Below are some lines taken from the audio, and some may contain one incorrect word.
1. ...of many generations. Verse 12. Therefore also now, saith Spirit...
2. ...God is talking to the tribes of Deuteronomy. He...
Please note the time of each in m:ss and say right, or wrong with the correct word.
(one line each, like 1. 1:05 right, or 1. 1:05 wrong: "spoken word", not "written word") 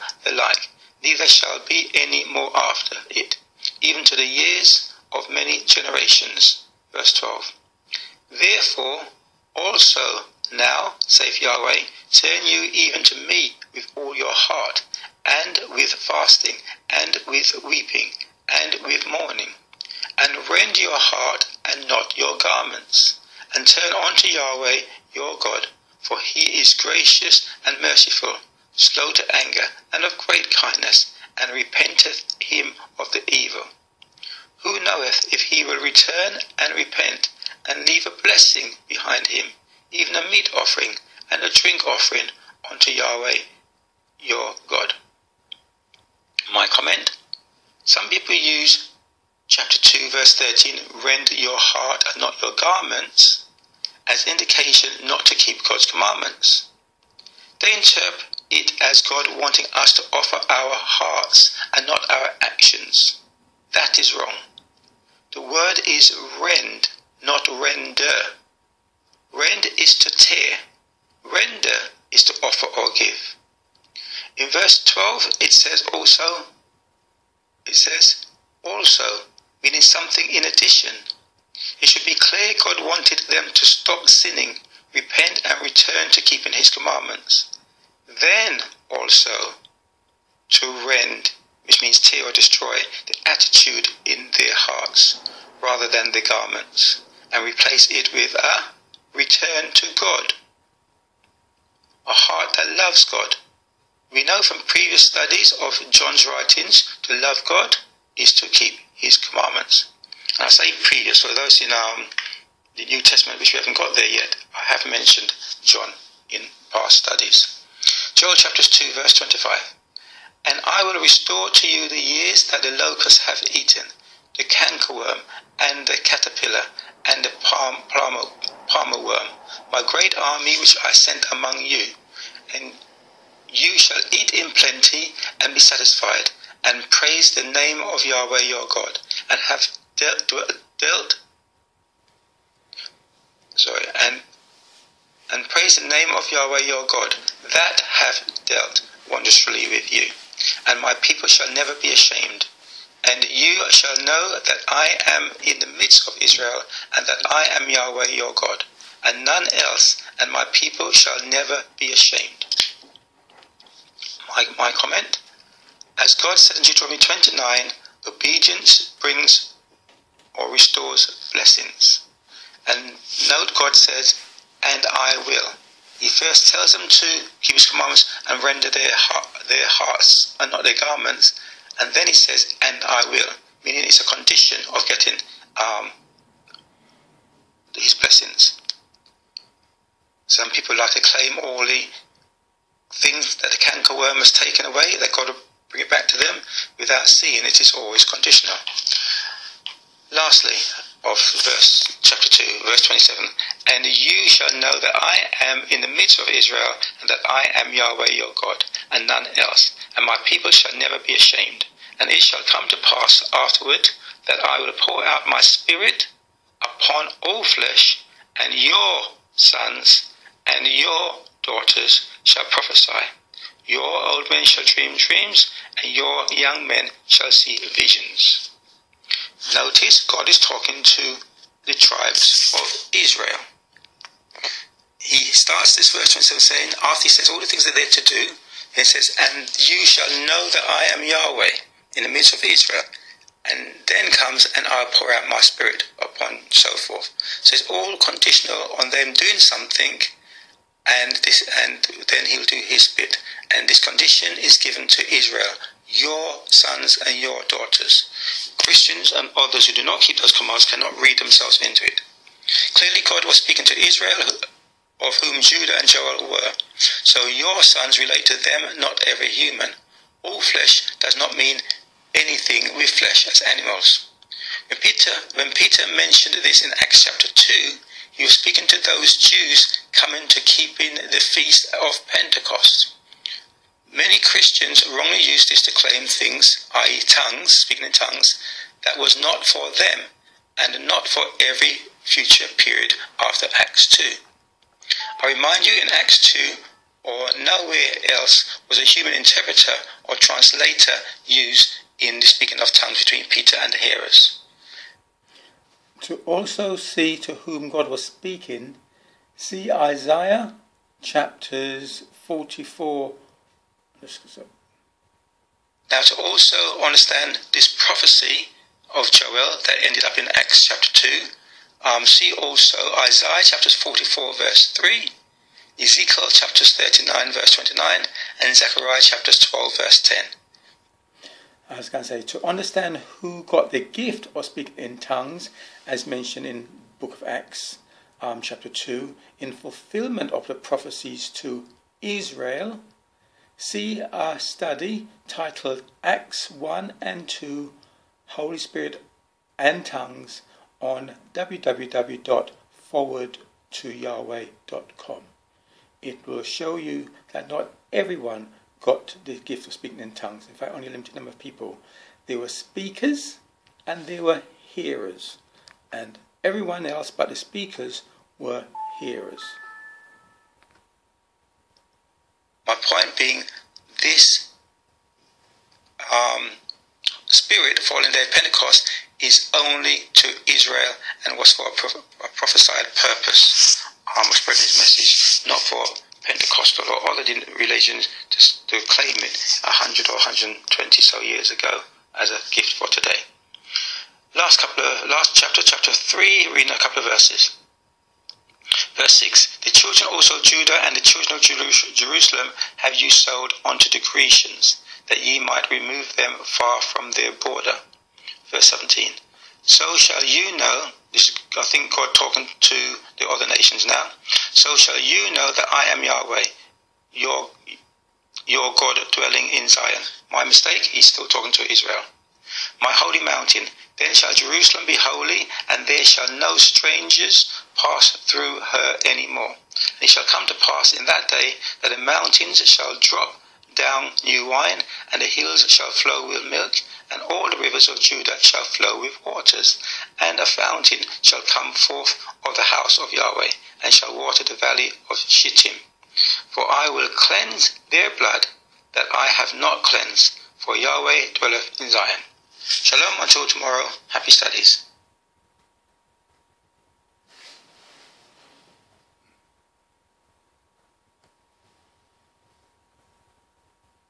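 1. 0:05 wrong: "Yahweh", not "Spirit"
2. 3:50 wrong: "Israel", not "Deuteronomy".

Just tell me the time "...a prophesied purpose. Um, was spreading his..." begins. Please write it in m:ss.
6:22.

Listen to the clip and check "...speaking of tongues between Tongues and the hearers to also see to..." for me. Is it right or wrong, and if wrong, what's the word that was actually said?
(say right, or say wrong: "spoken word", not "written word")
wrong: "Peter", not "Tongues".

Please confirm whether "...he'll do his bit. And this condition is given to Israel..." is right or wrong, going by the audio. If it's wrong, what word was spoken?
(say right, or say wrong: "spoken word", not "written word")
right.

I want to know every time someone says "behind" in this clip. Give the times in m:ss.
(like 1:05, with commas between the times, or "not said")
0:38.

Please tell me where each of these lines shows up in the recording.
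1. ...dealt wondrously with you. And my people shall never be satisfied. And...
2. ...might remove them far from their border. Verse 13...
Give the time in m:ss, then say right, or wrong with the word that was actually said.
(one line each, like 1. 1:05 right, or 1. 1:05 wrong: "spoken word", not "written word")
1. 2:28 wrong: "ashamed", not "satisfied"
2. 6:45 wrong: "17", not "13".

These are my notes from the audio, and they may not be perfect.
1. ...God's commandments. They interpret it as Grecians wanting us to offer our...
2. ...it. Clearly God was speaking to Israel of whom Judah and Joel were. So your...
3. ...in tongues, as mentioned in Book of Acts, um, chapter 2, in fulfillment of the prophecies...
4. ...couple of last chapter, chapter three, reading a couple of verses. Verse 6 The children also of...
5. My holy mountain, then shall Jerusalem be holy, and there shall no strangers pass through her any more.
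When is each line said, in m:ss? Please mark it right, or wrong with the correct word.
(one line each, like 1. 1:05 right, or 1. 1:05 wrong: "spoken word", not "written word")
1. 0:55 wrong: "God", not "Grecians"
2. 4:21 right
3. 5:34 right
4. 6:34 right
5. 7:02 right.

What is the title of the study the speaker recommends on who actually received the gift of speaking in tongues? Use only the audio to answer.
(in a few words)
Acts 1 and 2 Holy Spirit and Tongues.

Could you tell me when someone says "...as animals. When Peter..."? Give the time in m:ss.
4:33.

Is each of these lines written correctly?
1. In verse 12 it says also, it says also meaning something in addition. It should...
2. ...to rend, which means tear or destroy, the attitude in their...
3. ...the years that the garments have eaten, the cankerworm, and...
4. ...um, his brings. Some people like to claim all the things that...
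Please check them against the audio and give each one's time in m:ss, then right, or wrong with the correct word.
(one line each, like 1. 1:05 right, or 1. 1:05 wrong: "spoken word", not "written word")
1. 1:14 right
2. 1:30 right
3. 2:01 wrong: "locusts", not "garments"
4. 3:05 wrong: "blessings", not "brings".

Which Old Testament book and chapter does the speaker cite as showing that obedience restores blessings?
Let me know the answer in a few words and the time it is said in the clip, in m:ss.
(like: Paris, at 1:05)
Deuteronomy 29, at 2:46.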